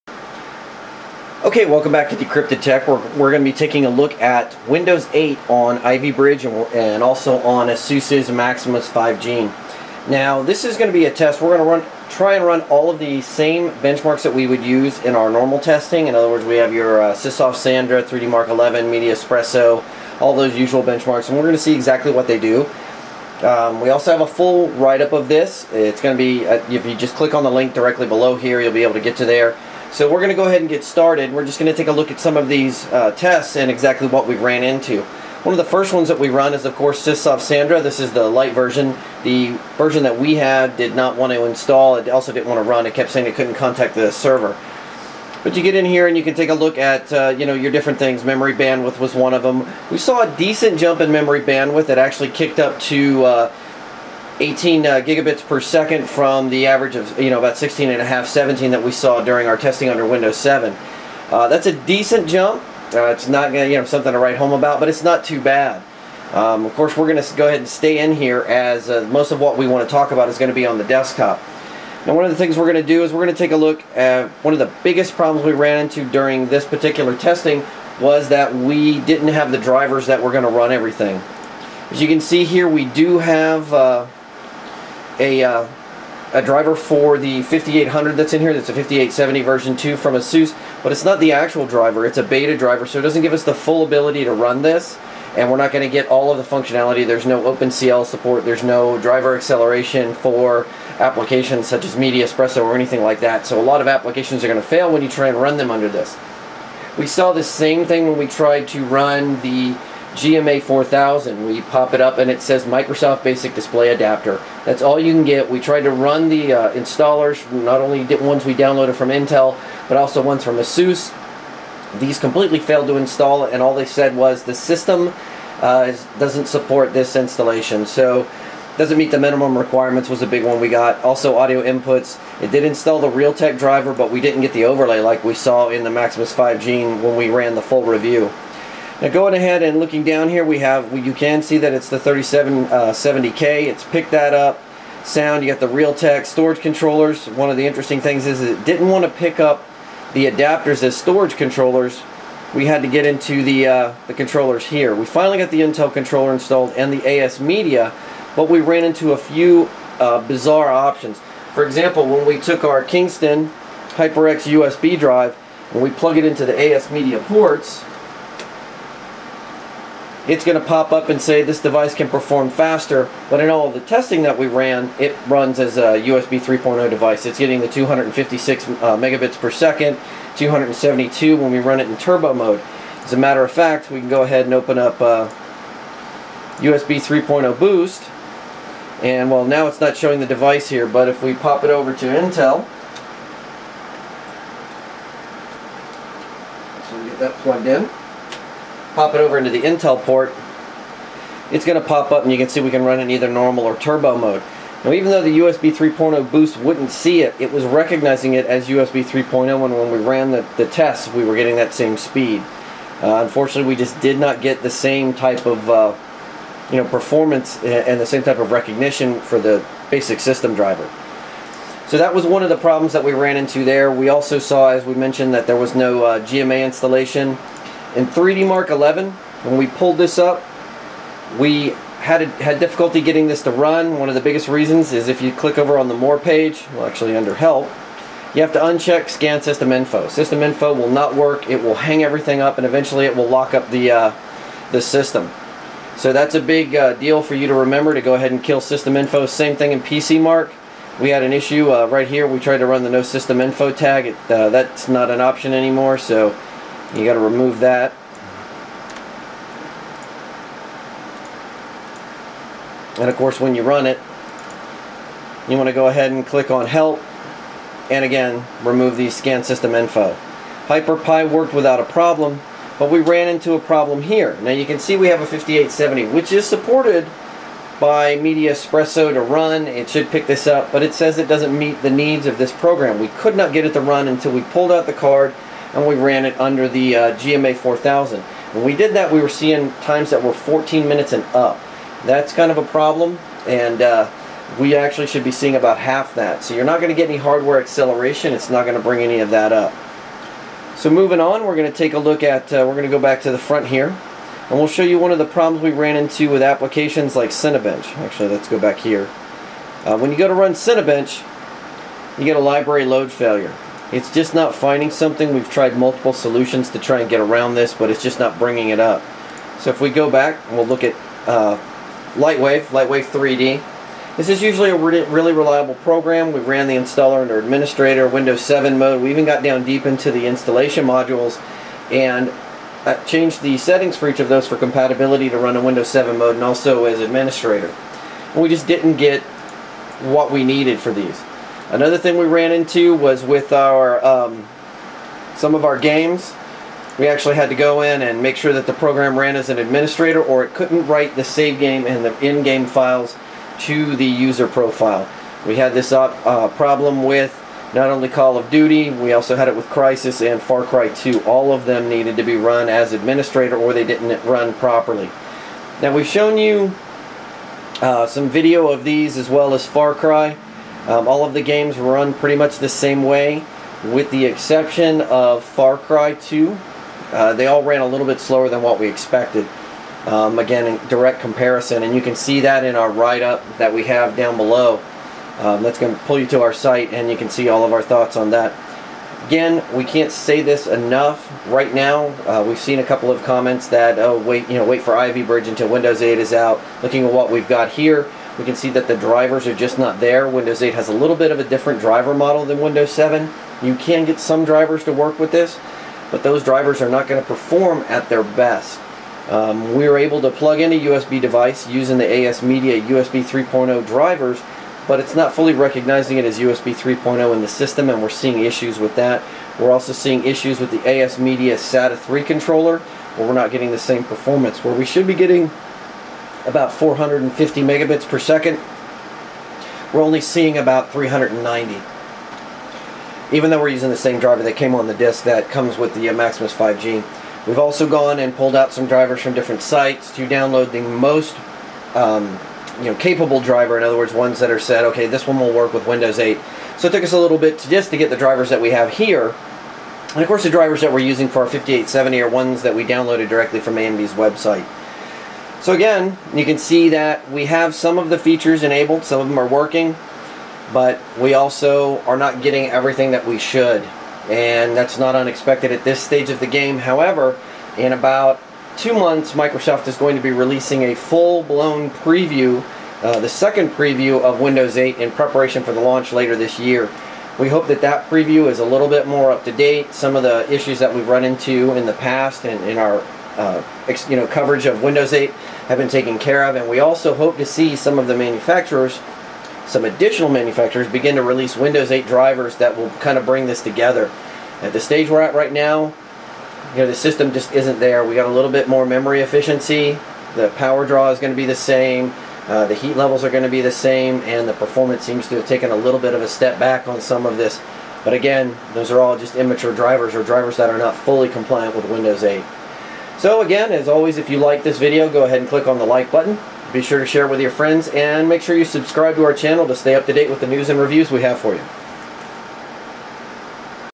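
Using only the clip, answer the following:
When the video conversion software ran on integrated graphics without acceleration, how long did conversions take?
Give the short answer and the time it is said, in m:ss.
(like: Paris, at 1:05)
14 minutes and up, at 4:50.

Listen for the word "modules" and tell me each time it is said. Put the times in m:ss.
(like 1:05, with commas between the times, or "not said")
5:30.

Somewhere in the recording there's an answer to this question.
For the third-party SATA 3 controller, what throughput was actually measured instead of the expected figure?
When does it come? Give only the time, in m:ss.
7:10.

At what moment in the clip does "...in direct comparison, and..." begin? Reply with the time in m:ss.
6:20.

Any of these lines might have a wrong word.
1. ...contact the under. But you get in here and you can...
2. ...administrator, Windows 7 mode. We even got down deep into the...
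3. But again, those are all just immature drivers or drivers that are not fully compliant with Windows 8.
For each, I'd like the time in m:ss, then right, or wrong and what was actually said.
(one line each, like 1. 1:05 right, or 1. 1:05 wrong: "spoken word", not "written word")
1. 0:43 wrong: "server", not "under"
2. 5:27 right
3. 8:28 right.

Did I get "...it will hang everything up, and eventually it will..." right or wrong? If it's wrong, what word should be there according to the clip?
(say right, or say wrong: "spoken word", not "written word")
right.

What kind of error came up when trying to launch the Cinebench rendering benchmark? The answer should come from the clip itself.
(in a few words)
library load failure.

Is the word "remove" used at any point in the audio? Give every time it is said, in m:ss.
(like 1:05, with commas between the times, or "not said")
4:17, 4:28.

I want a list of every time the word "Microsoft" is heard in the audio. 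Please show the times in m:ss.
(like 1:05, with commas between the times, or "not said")
1:52, 7:49.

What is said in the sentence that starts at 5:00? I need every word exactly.
So moving on, we're going to take a look at, uh, we're going to go back to the front here.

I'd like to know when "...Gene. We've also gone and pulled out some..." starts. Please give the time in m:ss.
7:16.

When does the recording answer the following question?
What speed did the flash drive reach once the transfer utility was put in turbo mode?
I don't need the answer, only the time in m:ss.
3:00.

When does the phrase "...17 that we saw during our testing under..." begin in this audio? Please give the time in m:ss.
0:58.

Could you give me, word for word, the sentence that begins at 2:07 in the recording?
So doesn't meet the minimum requirements was a big one we got.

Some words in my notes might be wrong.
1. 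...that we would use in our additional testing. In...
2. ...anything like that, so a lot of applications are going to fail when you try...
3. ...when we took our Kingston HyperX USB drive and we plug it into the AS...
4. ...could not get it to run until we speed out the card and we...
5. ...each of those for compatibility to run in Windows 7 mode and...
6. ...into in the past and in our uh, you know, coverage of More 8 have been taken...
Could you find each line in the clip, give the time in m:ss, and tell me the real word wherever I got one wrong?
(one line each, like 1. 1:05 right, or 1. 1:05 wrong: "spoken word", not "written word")
1. 0:14 wrong: "normal", not "additional"
2. 1:42 right
3. 2:42 right
4. 4:43 wrong: "pulled", not "speed"
5. 5:34 right
6. 8:01 wrong: "Windows", not "More".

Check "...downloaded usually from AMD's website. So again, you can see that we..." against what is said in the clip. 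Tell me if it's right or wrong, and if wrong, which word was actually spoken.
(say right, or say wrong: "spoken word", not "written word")
wrong: "directly", not "usually".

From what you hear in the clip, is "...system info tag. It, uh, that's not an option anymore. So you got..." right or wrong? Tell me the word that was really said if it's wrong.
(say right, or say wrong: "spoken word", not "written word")
right.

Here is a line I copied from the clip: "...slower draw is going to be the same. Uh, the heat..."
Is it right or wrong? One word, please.
wrong.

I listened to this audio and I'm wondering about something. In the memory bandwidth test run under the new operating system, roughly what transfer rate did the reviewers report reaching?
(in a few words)
18 gigabits per second.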